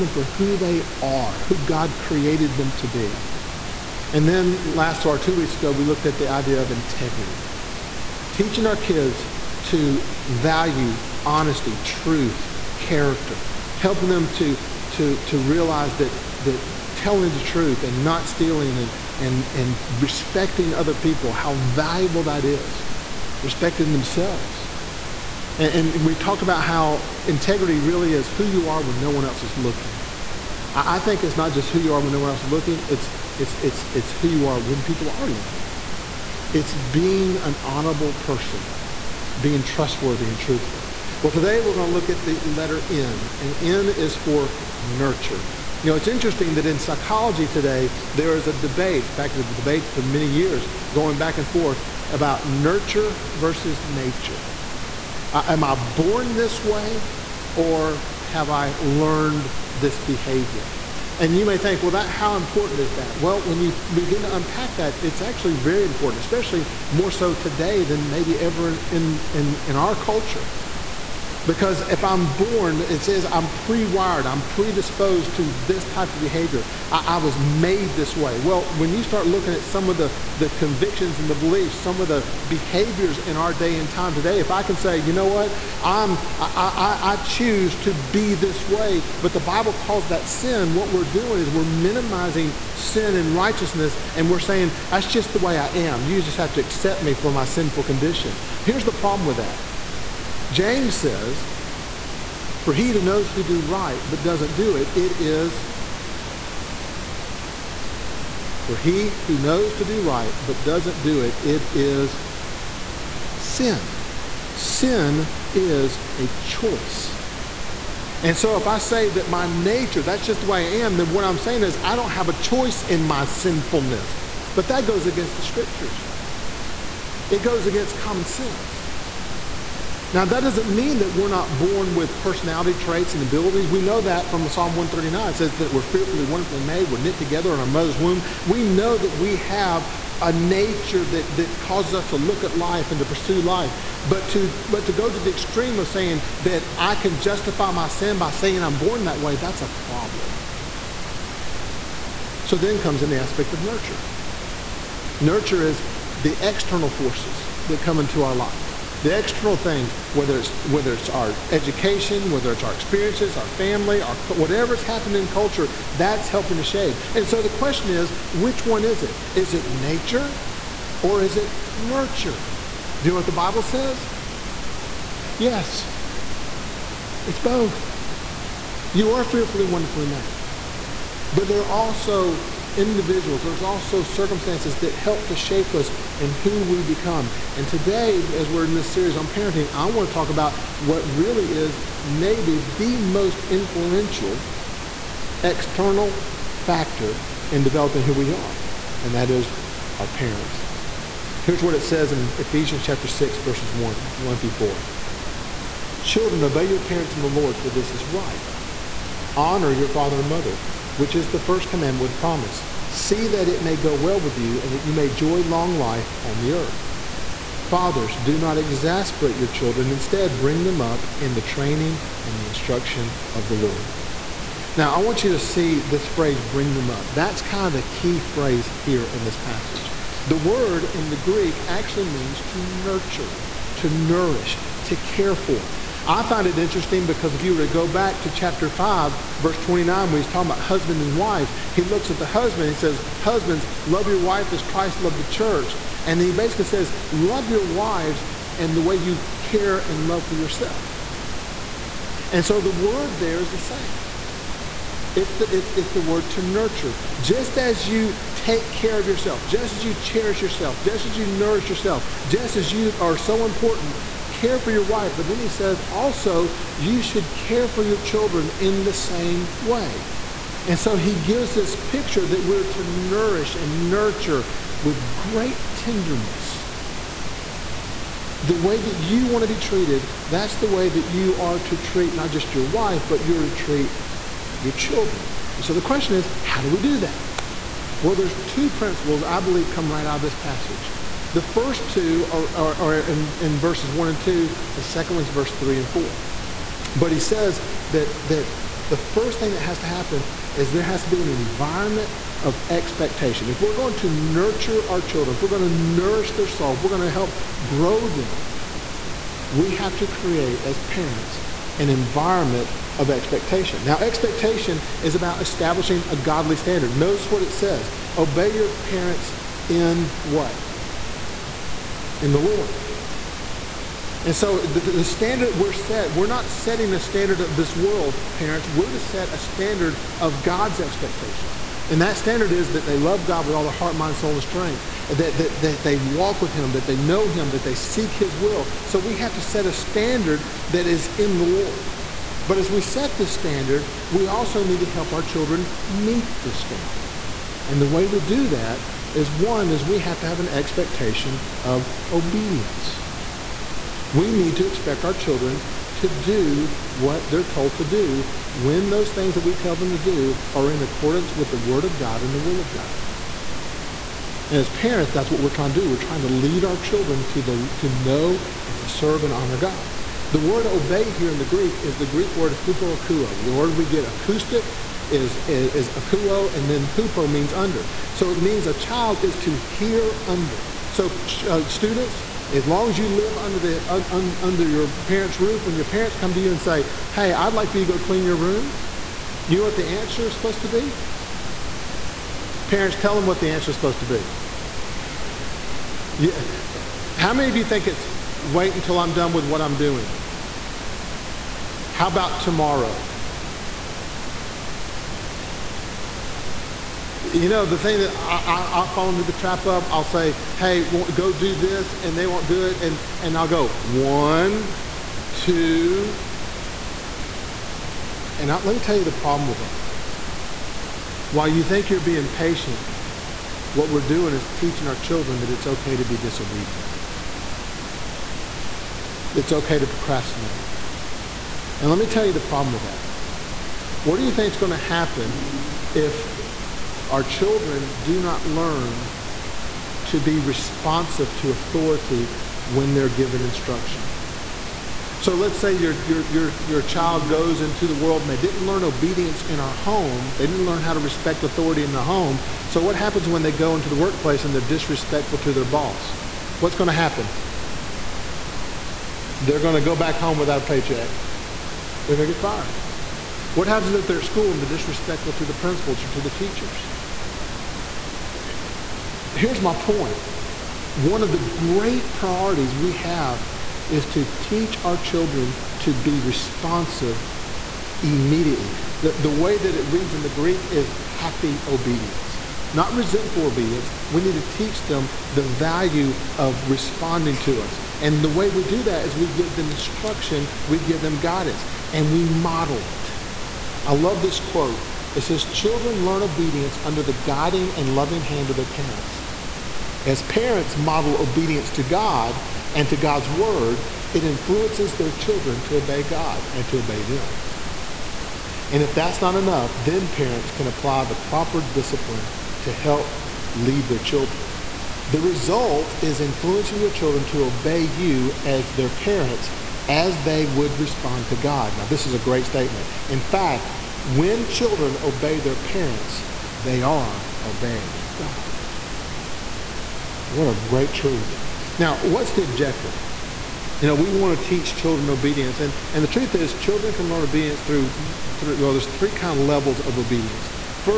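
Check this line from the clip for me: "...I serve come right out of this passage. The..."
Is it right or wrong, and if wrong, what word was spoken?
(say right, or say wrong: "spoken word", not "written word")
wrong: "believe", not "serve".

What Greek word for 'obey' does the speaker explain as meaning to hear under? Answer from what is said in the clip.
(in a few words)
hupoakuo.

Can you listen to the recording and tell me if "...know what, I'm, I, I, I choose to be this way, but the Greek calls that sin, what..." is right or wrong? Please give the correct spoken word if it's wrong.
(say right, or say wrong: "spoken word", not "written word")
wrong: "Bible", not "Greek".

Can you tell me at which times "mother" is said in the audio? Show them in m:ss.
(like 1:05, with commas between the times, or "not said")
2:17, 3:30.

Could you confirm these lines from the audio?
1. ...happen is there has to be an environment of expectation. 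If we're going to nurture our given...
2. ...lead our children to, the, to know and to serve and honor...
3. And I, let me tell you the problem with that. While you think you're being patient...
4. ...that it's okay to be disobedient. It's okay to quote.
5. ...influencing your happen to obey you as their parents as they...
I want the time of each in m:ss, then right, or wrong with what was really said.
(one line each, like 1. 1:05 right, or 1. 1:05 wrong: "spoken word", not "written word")
1. 4:59 wrong: "children", not "given"
2. 6:06 right
3. 6:58 right
4. 7:05 wrong: "procrastinate", not "quote"
5. 8:36 wrong: "children", not "happen".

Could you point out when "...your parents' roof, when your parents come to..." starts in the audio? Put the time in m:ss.
6:24.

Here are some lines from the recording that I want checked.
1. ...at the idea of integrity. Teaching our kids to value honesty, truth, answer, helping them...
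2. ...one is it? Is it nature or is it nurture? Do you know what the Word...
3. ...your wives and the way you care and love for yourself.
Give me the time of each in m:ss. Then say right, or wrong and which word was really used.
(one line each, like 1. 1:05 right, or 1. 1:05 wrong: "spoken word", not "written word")
1. 0:06 wrong: "character", not "answer"
2. 2:48 wrong: "Bible", not "Word"
3. 4:07 right.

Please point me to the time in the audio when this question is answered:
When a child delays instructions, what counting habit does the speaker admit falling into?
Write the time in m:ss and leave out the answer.
6:53.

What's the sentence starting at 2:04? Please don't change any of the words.
But that goes against the scriptures, it goes against common sense.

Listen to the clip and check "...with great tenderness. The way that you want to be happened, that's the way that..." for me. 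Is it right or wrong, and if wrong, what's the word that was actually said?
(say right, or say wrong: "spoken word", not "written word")
wrong: "treated", not "happened".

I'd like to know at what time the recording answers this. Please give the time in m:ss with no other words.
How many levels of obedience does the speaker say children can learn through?
8:58.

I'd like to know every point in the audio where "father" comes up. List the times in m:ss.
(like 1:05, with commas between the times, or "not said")
3:29, 3:37.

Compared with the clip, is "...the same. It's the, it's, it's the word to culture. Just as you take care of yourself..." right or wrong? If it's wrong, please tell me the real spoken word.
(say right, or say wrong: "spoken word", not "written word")
wrong: "nurture", not "culture".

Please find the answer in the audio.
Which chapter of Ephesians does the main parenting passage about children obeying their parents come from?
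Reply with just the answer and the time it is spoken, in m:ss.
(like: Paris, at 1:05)
Chapter 6, at 3:22.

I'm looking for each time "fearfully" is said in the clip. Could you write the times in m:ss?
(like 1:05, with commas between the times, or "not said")
2:15, 2:59.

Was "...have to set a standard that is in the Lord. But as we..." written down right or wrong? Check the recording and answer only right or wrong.
right.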